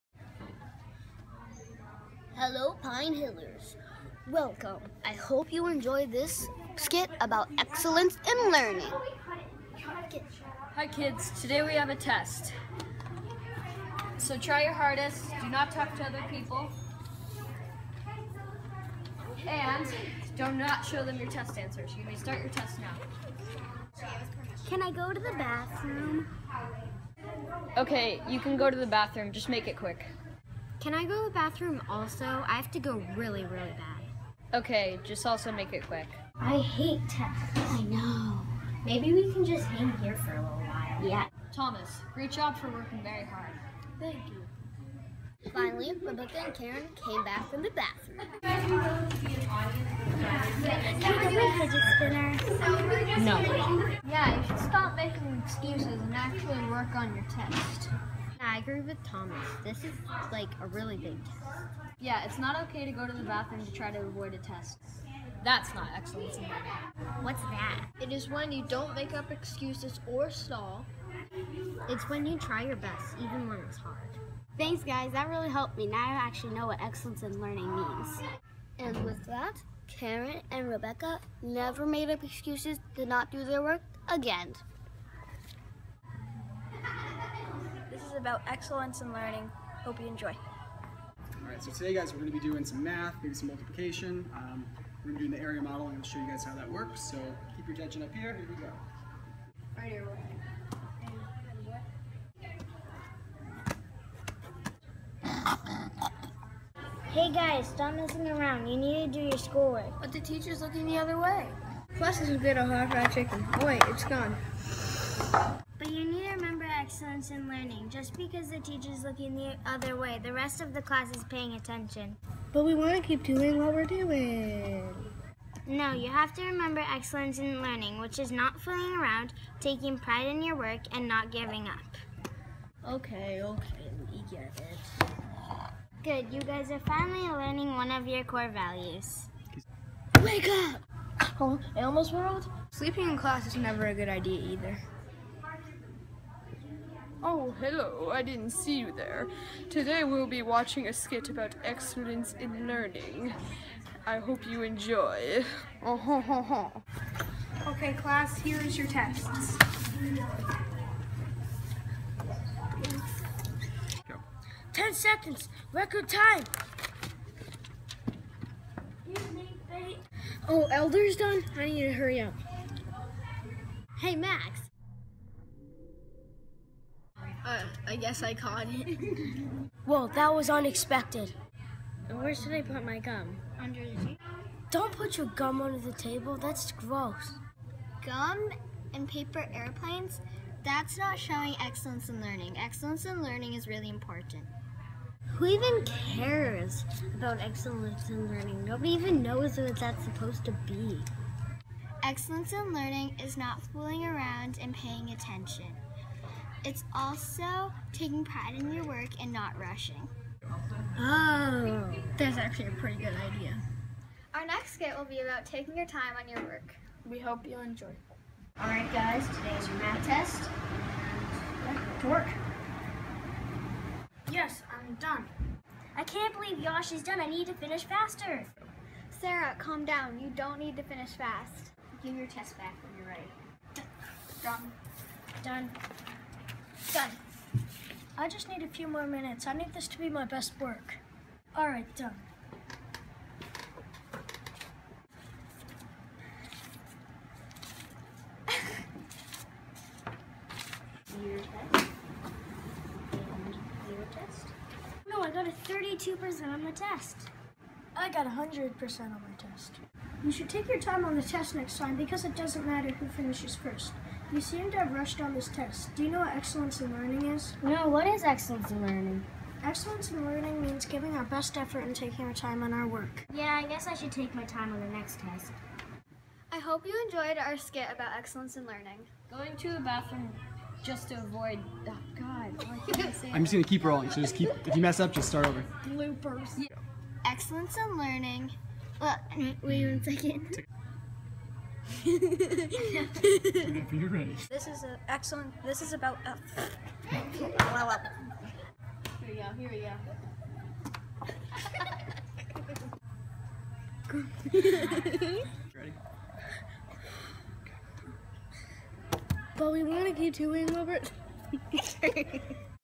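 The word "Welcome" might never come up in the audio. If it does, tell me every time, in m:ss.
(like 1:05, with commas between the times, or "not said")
0:04.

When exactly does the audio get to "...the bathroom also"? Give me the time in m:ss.
0:31.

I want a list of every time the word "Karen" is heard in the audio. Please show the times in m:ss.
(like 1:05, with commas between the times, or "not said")
0:46, 1:19.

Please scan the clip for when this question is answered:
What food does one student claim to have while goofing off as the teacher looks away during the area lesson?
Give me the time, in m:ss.
1:52.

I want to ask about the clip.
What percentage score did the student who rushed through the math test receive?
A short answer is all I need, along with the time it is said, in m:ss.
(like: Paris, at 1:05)
32%, at 4:15.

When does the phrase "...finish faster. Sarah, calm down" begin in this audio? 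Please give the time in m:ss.
3:47.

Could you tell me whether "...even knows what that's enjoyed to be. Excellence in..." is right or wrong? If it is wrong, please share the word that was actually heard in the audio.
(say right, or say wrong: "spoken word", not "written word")
wrong: "supposed", not "enjoyed".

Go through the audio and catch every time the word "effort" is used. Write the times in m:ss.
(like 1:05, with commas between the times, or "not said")
4:31.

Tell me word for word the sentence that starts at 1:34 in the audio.
Um, we're going to be doing the area and I'll show you guys how that works.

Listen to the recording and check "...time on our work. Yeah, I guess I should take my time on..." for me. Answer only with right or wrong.
right.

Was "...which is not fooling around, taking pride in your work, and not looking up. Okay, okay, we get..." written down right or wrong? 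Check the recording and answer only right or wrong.
wrong.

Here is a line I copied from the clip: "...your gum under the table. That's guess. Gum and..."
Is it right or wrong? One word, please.
wrong.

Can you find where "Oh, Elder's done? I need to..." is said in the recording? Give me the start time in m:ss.
2:50.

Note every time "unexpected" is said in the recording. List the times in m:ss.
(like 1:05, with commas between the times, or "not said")
3:00.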